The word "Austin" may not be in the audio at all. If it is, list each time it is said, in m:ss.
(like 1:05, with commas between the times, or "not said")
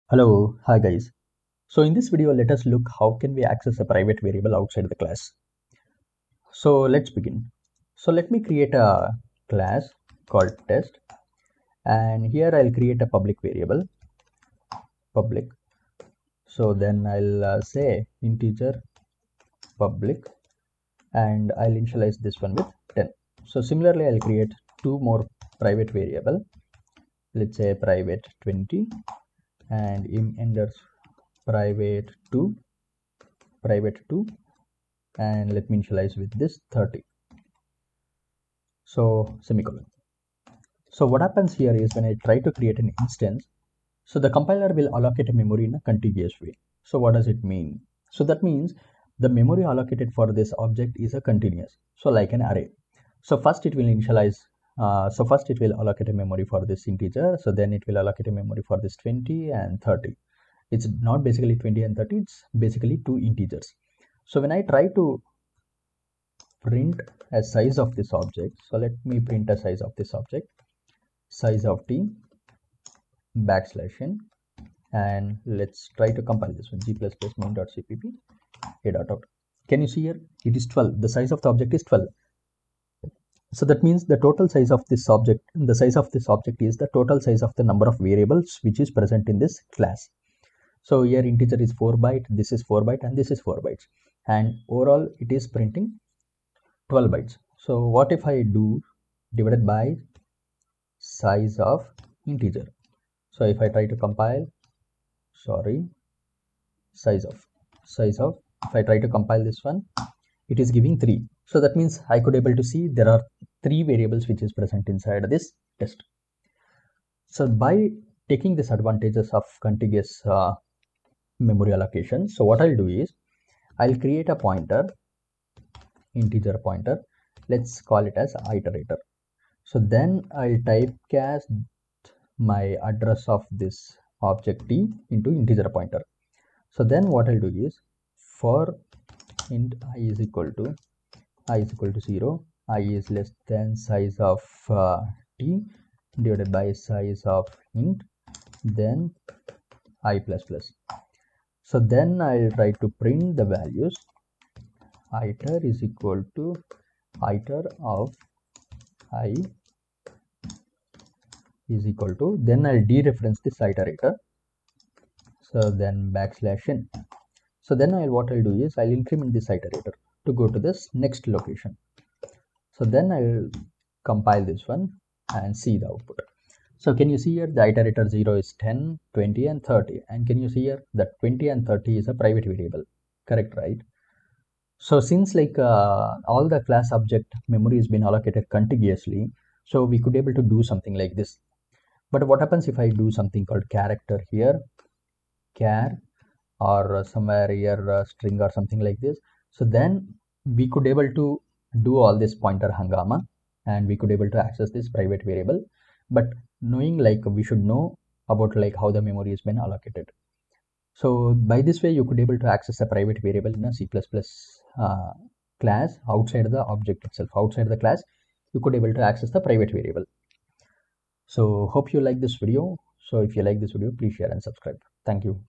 not said.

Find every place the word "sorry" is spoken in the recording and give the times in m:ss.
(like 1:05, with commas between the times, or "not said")
1:45.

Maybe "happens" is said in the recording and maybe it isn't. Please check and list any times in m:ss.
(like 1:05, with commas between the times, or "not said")
0:41, 3:12.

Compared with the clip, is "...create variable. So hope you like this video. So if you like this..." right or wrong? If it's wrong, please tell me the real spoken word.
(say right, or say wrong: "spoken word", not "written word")
wrong: "private", not "create".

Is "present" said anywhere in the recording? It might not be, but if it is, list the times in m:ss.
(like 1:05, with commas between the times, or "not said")
1:28, 1:54.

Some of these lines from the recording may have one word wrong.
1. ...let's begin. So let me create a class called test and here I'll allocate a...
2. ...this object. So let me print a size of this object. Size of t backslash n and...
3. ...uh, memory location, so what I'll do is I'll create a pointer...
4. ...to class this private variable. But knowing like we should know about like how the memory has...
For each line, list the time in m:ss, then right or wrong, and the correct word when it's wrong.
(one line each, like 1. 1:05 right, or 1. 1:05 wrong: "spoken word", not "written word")
1. 0:06 wrong: "create", not "allocate"
2. 1:07 right
3. 2:00 wrong: "allocation", not "location"
4. 3:24 wrong: "access", not "class".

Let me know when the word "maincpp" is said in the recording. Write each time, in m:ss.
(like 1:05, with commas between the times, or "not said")
1:17.